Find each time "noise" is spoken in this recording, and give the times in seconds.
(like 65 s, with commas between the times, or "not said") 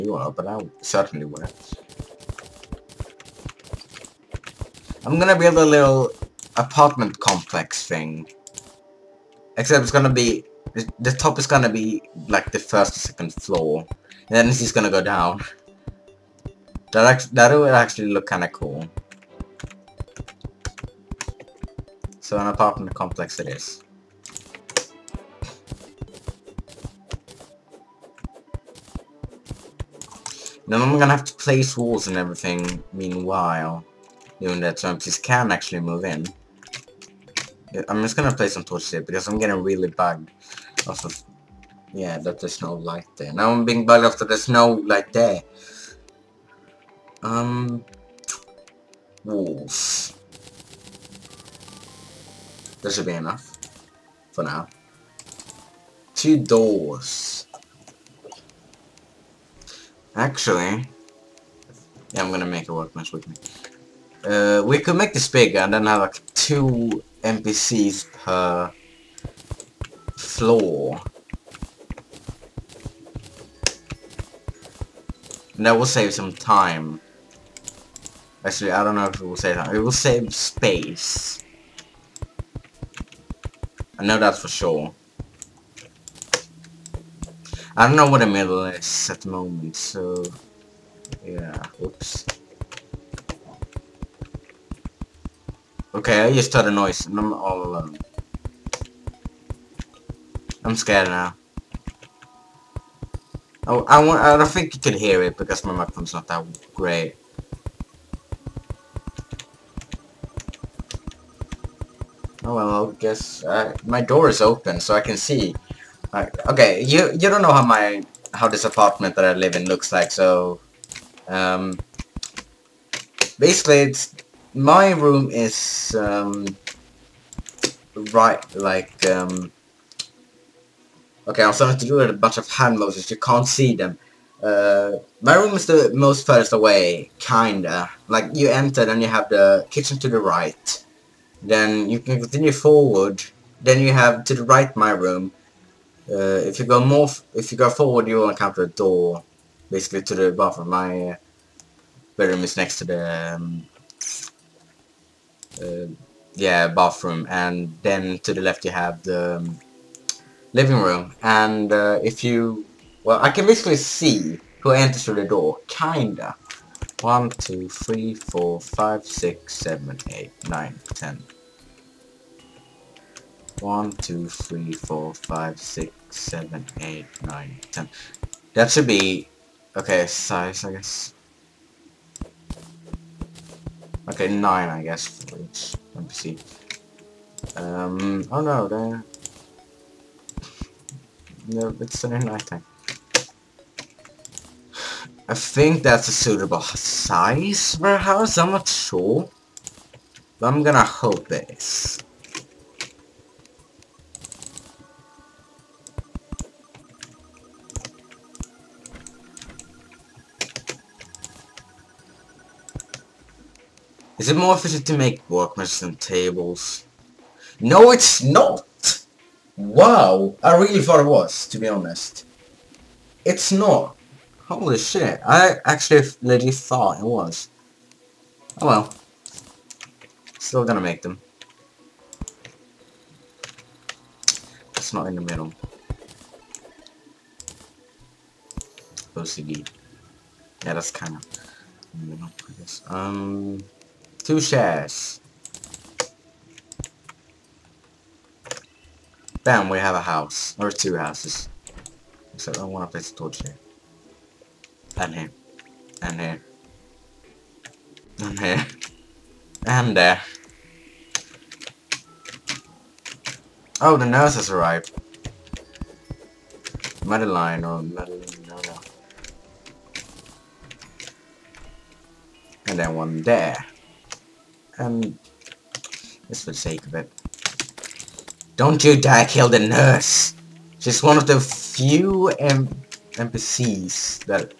96 s.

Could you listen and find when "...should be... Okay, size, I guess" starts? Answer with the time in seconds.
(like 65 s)
178 s.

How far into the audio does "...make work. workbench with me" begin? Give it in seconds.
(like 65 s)
62 s.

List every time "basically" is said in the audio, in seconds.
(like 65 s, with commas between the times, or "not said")
123 s, 149 s, 163 s.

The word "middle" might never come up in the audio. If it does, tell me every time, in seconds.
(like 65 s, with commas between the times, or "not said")
88 s, 235 s, 242 s.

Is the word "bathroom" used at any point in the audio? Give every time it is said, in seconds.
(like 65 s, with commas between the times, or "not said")
150 s, 156 s.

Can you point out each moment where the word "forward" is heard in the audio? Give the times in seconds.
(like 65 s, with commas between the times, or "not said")
142 s, 147 s.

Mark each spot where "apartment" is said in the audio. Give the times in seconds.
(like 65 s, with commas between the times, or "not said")
6 s, 22 s, 118 s.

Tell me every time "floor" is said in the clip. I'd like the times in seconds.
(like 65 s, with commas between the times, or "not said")
13 s, 70 s.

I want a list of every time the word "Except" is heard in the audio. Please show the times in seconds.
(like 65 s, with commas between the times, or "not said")
9 s, 252 s.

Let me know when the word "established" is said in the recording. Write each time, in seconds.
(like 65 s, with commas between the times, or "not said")
not said.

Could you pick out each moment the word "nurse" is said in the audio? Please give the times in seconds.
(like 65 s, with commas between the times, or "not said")
264 s, 279 s.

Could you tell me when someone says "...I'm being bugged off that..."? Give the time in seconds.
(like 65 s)
43 s.